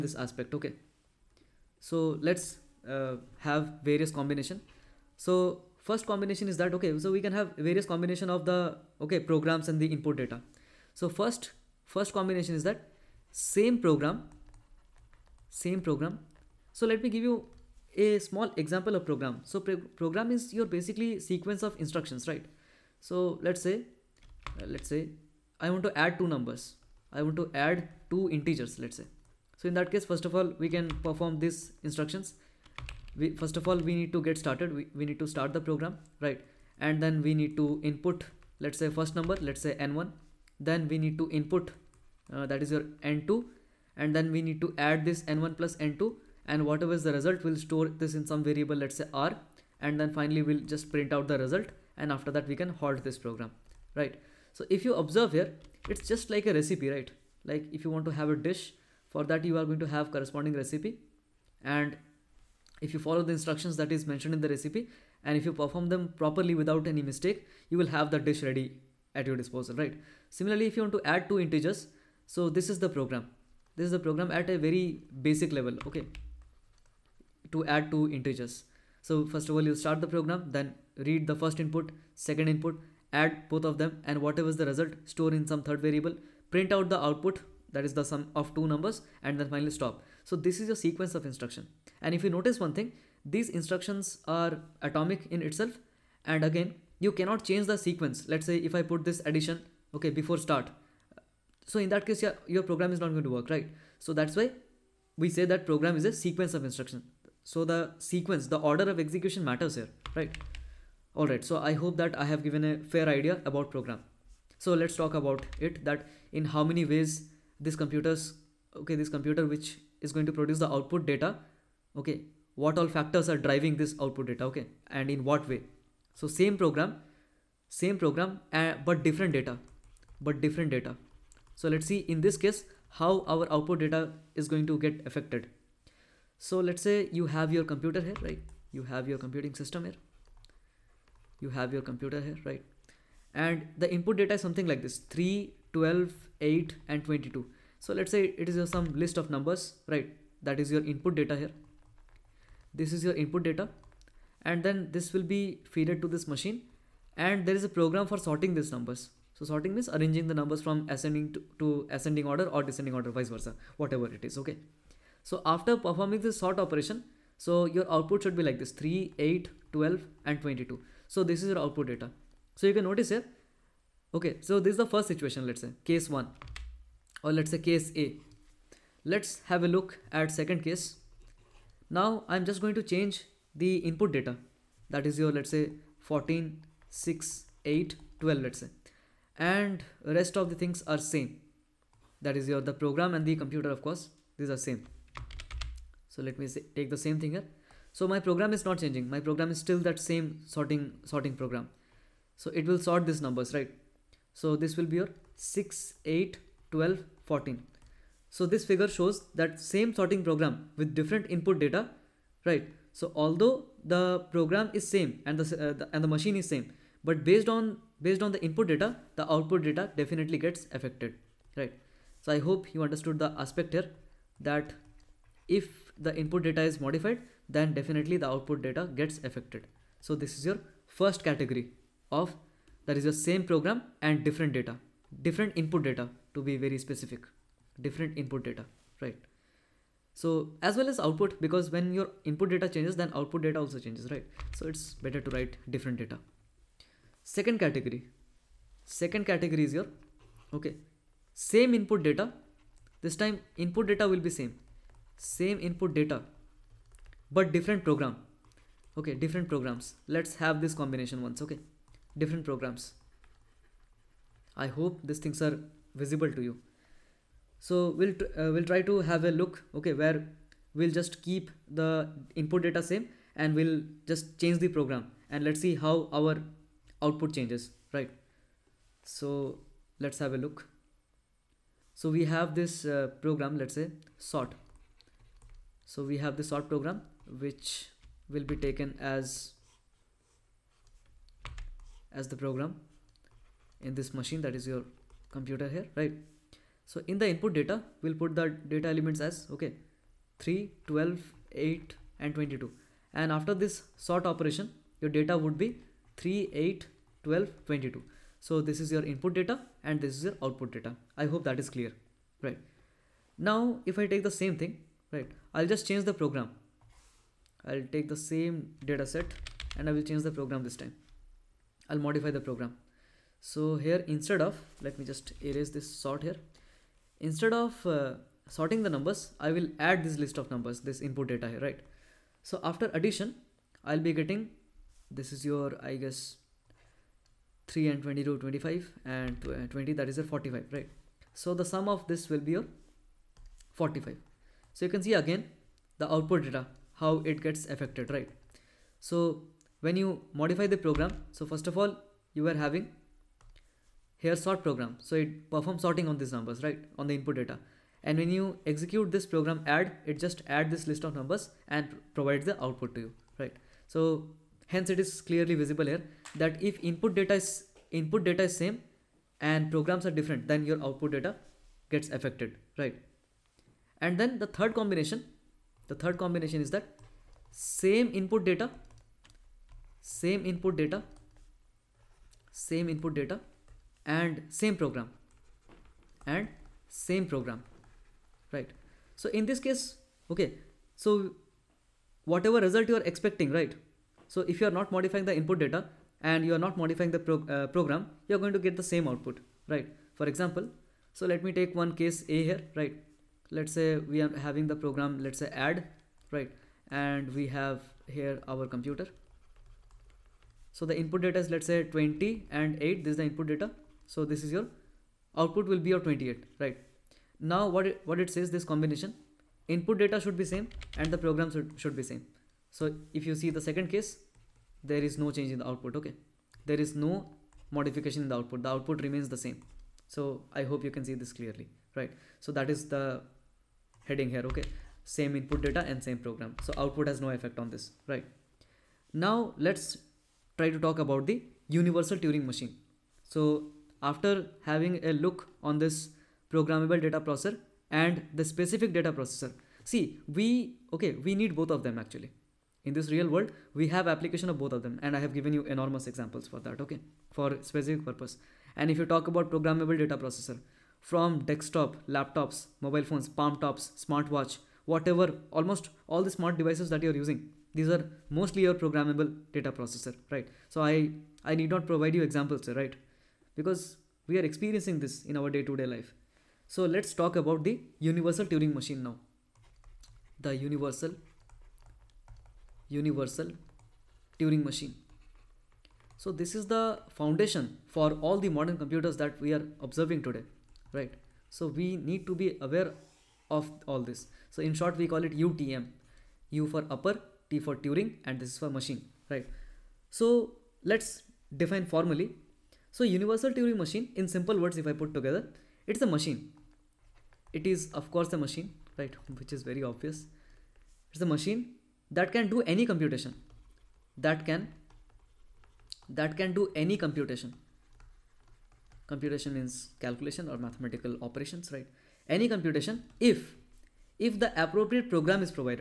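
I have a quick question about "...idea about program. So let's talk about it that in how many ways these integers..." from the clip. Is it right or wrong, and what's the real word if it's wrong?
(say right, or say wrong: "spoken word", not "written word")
wrong: "computers", not "integers".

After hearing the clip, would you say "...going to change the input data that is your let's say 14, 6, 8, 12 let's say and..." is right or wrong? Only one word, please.
right.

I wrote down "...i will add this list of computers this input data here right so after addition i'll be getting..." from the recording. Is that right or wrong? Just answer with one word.
wrong.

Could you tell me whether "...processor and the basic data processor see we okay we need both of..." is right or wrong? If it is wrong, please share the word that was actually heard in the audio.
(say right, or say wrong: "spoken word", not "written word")
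wrong: "specific", not "basic".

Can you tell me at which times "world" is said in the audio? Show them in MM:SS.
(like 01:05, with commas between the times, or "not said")
07:33.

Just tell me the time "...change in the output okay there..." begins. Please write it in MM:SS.
07:05.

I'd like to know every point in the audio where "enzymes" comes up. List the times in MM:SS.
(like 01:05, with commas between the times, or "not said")
not said.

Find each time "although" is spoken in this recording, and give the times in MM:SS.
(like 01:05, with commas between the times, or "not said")
03:33.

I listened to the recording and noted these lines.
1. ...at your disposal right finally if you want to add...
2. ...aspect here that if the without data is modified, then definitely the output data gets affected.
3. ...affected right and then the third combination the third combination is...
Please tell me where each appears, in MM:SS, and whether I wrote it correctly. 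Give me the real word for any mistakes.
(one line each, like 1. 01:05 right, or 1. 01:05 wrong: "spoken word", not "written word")
1. 01:09 wrong: "similarly", not "finally"
2. 03:43 wrong: "input", not "without"
3. 06:12 right.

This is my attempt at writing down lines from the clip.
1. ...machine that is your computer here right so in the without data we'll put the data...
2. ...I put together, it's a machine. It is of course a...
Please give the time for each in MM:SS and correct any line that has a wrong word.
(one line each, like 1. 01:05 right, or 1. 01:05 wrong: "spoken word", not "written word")
1. 04:54 wrong: "input", not "without"
2. 08:24 right.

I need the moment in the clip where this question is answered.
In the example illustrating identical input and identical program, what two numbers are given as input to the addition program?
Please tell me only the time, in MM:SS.
06:51.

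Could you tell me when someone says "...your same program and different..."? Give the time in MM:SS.
03:53.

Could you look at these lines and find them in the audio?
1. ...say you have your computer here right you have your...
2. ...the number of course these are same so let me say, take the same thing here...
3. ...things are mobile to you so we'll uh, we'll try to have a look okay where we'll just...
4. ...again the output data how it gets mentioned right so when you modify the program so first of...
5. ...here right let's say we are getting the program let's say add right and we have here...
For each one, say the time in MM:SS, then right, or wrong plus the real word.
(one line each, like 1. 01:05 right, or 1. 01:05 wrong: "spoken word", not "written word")
1. 02:16 right
2. 03:13 wrong: "computer", not "number"
3. 04:25 wrong: "visible", not "mobile"
4. 05:45 wrong: "affected", not "mentioned"
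5. 06:42 wrong: "having", not "getting".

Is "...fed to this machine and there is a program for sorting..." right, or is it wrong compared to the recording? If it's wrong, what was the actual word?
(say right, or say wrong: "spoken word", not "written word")
right.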